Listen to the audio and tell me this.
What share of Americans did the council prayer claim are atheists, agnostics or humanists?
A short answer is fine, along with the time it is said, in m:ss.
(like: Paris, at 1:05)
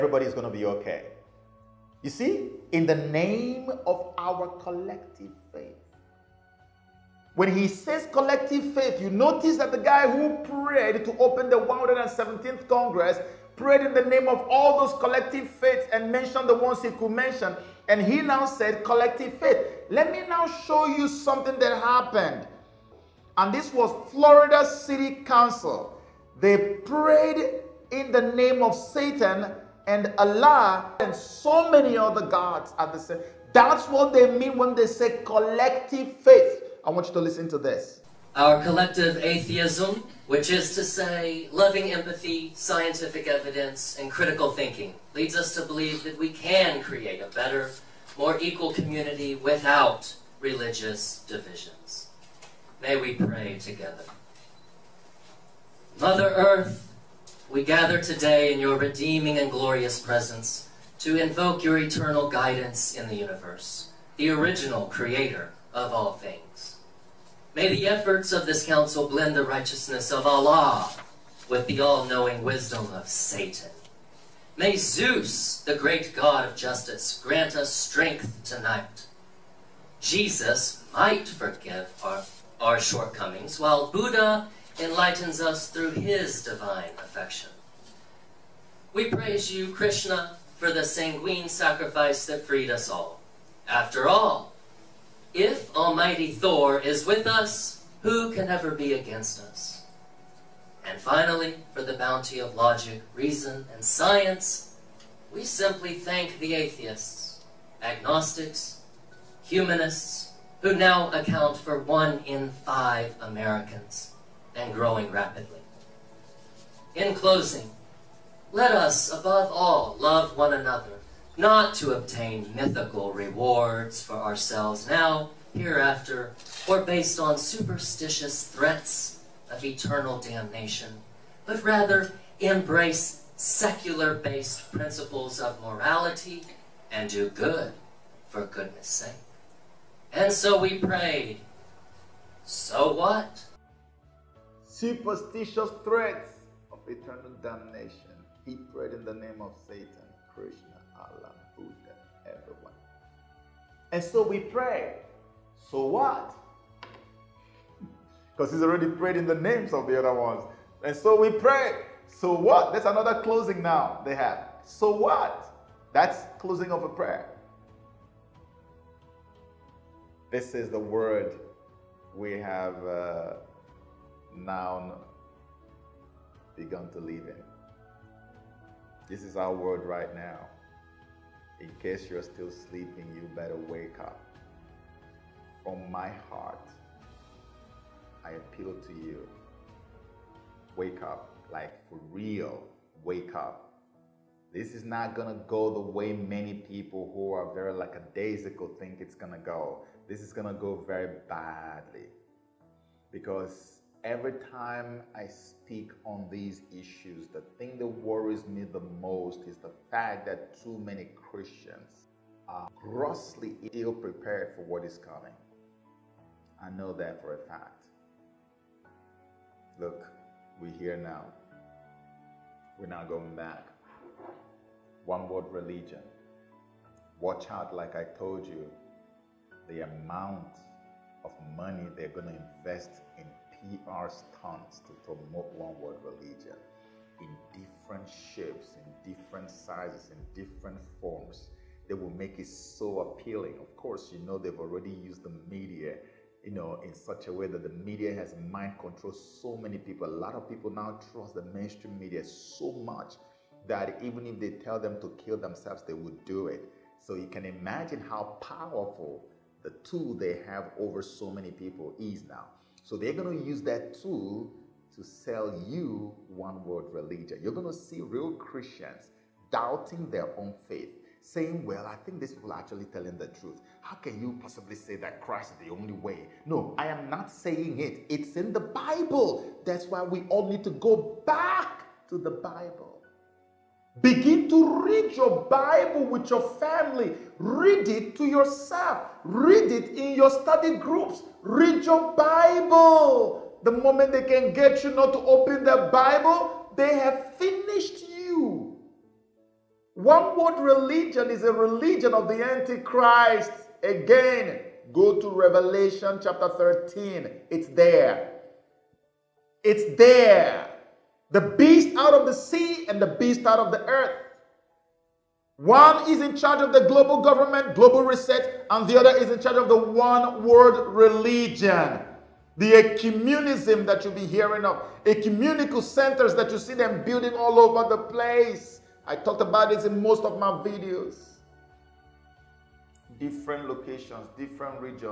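One in five, at 1:51.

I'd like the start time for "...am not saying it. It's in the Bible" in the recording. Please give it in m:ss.
4:36.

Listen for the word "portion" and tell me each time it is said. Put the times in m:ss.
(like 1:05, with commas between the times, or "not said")
not said.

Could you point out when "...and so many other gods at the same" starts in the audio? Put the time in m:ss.
0:30.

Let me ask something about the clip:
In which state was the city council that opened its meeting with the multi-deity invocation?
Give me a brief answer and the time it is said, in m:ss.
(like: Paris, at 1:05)
Florida, at 0:24.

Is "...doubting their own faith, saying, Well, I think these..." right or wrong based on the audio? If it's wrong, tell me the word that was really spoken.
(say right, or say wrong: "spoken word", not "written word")
right.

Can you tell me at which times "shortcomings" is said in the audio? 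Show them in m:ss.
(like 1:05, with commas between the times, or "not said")
1:22.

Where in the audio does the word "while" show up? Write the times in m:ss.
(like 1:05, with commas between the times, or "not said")
1:23.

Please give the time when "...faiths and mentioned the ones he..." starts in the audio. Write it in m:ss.
0:15.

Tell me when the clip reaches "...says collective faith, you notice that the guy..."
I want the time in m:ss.
0:07.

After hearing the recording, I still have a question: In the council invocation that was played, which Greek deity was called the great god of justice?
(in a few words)
Zeus.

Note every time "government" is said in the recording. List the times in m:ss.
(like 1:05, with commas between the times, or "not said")
5:17.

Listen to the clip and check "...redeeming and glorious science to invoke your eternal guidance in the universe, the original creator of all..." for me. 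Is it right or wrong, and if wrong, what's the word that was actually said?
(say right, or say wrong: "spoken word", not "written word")
wrong: "presence", not "science".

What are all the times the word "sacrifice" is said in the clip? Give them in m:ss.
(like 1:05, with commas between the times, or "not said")
1:31.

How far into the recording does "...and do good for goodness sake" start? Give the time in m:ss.
2:16.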